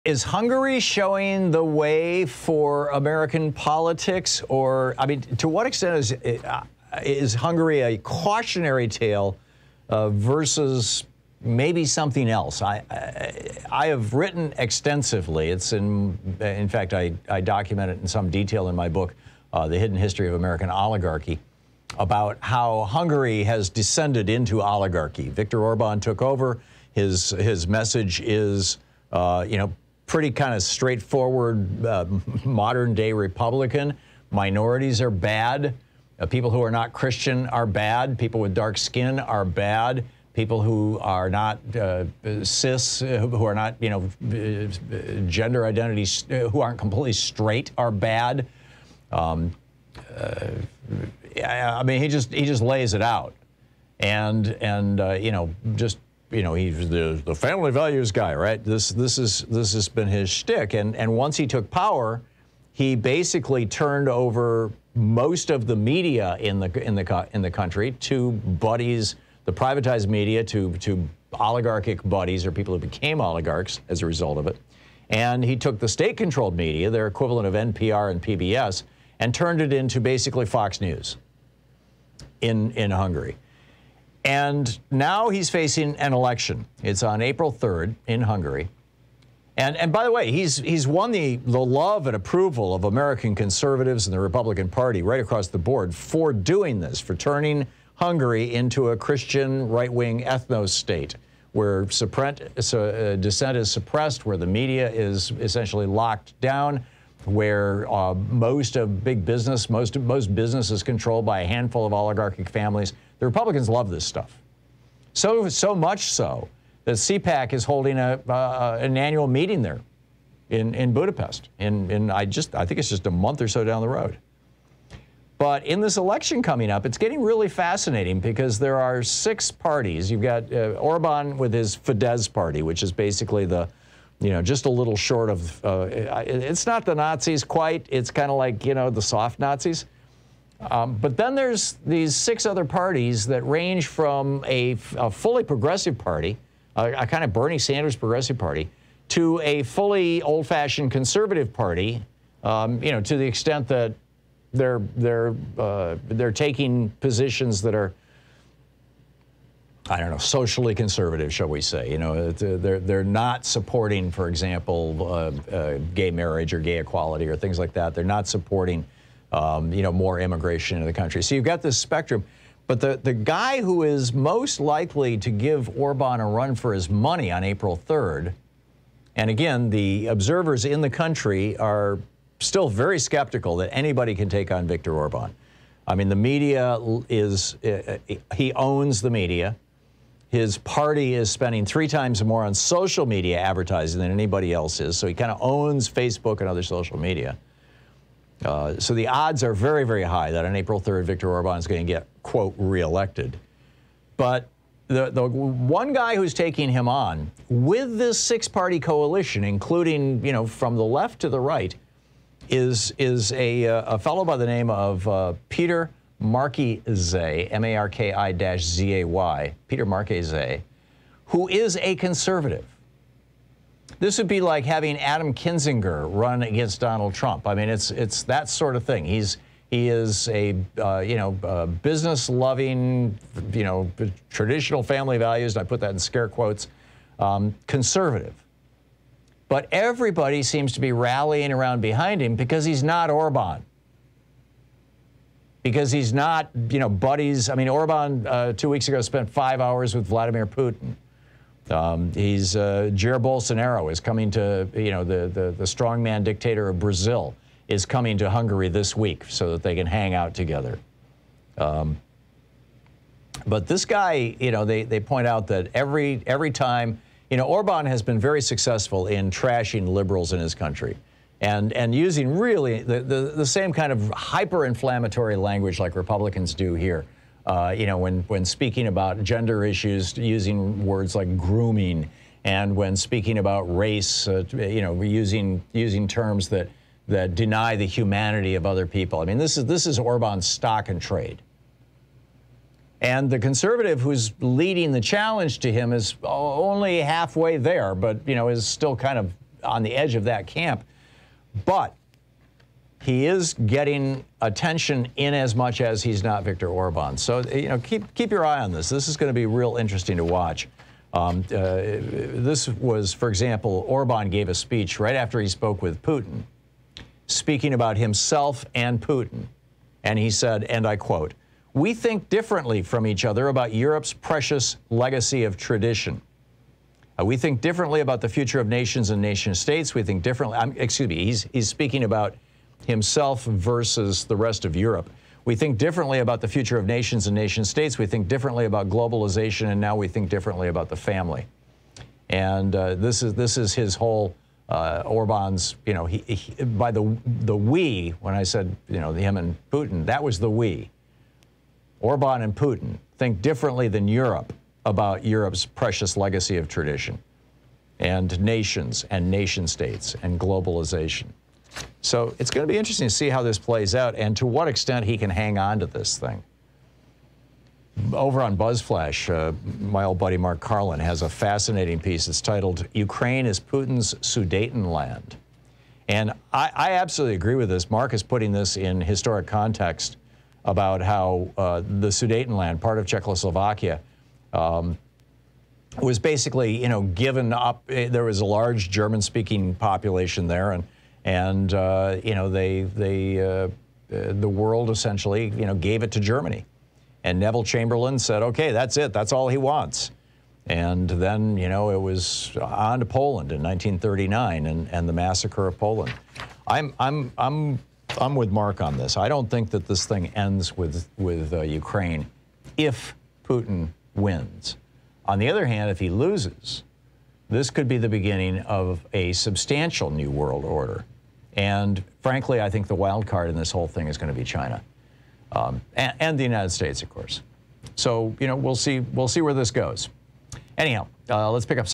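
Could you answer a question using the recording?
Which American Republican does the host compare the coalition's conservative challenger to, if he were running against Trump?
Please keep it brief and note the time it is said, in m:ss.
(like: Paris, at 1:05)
Adam Kinzinger, at 3:44.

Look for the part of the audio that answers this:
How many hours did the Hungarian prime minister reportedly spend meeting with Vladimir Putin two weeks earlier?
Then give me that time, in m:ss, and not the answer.
4:09.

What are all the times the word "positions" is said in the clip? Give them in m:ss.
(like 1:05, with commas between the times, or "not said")
2:36.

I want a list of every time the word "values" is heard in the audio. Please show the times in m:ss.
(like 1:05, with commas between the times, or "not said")
0:57, 3:55.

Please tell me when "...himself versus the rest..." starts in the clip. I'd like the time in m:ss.
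5:32.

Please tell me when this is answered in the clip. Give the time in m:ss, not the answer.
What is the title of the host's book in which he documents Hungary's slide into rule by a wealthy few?
0:19.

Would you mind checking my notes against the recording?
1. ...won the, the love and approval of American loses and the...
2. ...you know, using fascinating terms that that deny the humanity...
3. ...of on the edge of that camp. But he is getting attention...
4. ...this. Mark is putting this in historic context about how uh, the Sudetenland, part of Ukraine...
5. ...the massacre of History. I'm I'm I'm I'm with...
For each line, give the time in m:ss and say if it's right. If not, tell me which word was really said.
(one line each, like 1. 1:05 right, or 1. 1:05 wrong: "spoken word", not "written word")
1. 1:30 wrong: "conservatives", not "loses"
2. 4:44 wrong: "using", not "fascinating"
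3. 4:59 right
4. 6:17 wrong: "Czechoslovakia", not "Ukraine"
5. 6:45 wrong: "Poland", not "History".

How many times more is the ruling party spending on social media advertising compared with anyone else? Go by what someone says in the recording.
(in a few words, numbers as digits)
3.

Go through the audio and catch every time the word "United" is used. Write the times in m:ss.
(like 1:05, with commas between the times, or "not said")
7:06.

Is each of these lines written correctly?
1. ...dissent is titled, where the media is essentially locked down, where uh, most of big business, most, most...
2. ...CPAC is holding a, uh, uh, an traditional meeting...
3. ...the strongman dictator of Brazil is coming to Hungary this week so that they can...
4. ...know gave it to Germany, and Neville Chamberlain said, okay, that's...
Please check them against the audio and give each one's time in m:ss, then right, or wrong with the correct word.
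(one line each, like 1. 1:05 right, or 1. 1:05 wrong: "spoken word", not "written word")
1. 1:43 wrong: "suppressed", not "titled"
2. 1:56 wrong: "annual", not "traditional"
3. 4:15 right
4. 6:35 right.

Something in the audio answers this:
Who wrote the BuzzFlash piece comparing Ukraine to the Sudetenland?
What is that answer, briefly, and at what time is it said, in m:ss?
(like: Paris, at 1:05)
Mark Karlin, at 6:10.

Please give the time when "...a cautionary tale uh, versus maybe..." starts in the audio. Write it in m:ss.
0:07.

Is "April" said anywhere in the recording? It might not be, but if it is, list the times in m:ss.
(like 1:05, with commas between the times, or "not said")
1:27, 2:57, 3:20.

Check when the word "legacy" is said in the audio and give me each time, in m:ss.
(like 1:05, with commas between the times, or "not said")
5:24, 5:56.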